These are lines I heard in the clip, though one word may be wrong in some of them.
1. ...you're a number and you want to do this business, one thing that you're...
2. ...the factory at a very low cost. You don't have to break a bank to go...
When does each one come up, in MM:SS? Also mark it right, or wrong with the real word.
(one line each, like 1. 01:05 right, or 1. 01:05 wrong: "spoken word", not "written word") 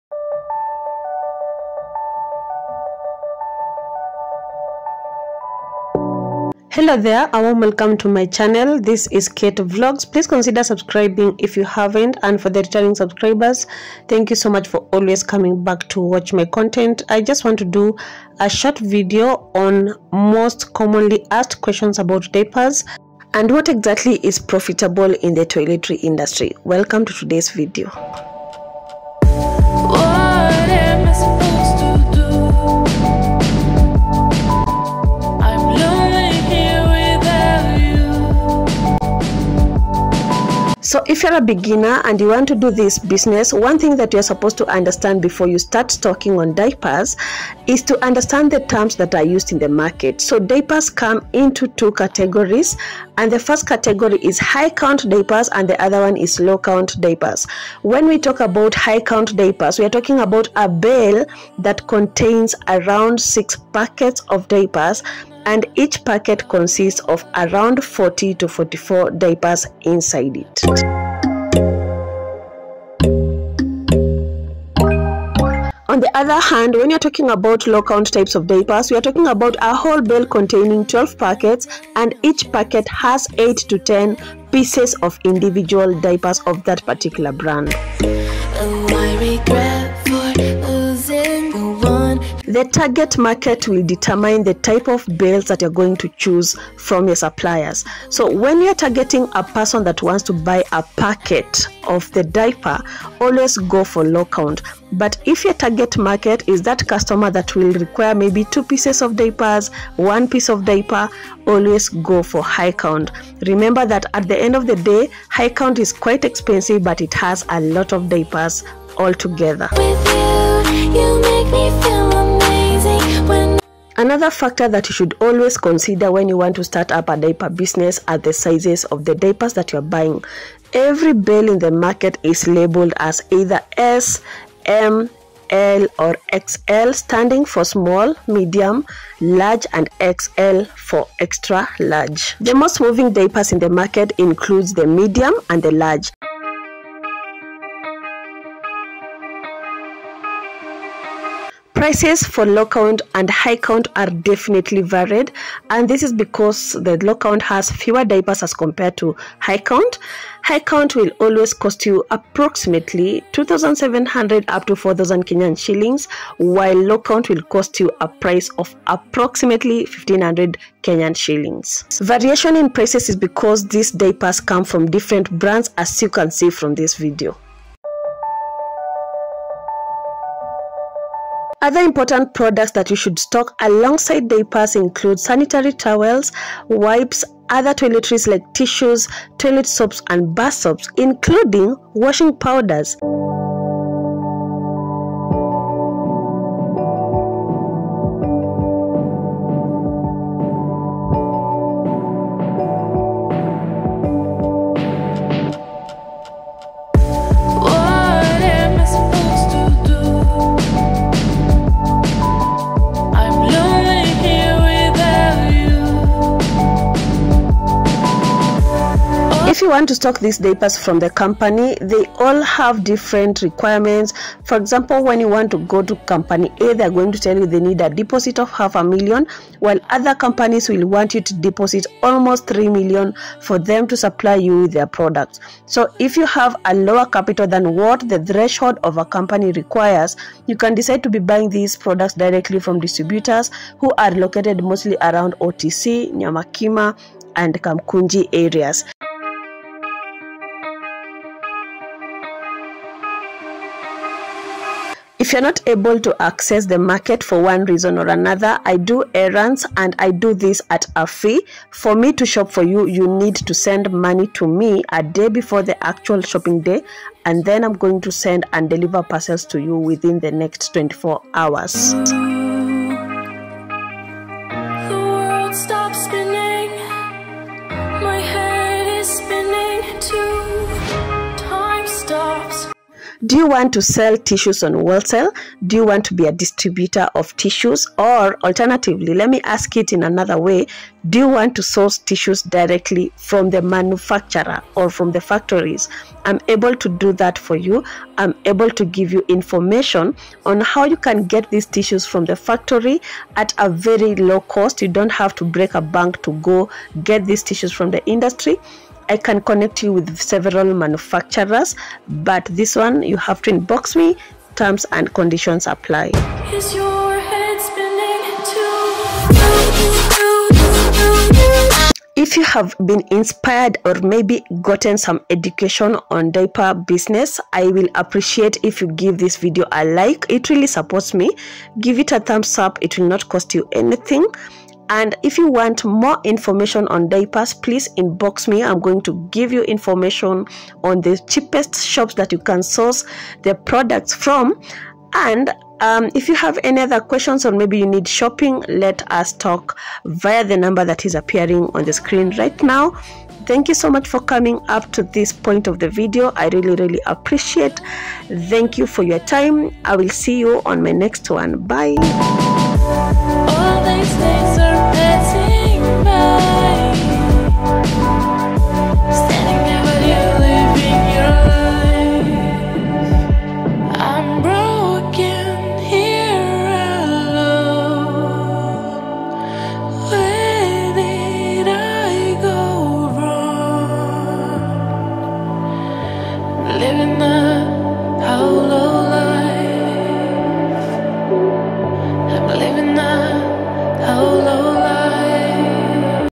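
1. 00:41 wrong: "beginner", not "number"
2. 05:02 right.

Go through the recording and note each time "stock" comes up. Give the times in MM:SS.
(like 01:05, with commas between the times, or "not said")
03:03, 03:39.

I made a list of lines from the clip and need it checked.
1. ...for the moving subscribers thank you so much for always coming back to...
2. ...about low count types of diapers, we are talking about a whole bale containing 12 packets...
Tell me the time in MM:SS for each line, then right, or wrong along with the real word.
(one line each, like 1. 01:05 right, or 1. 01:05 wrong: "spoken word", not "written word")
1. 00:12 wrong: "returning", not "moving"
2. 01:17 right.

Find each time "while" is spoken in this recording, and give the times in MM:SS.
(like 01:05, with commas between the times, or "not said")
02:46, 03:49.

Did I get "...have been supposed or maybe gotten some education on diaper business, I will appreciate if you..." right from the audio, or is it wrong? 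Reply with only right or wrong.
wrong.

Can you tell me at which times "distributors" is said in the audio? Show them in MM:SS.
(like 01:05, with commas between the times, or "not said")
04:02, 04:46.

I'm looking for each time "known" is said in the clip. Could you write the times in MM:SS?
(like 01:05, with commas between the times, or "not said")
not said.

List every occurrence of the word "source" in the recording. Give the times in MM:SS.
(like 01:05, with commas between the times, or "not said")
04:51, 05:42.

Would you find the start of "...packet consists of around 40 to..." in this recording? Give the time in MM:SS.
01:06.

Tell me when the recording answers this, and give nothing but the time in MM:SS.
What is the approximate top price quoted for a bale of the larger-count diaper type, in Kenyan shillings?
02:44.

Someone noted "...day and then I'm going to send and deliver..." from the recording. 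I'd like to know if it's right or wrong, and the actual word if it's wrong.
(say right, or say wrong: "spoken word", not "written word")
right.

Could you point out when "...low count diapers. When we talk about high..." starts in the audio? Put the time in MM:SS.
00:56.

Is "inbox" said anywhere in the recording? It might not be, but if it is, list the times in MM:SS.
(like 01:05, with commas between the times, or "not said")
05:13, 05:37.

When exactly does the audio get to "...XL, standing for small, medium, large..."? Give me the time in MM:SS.
02:16.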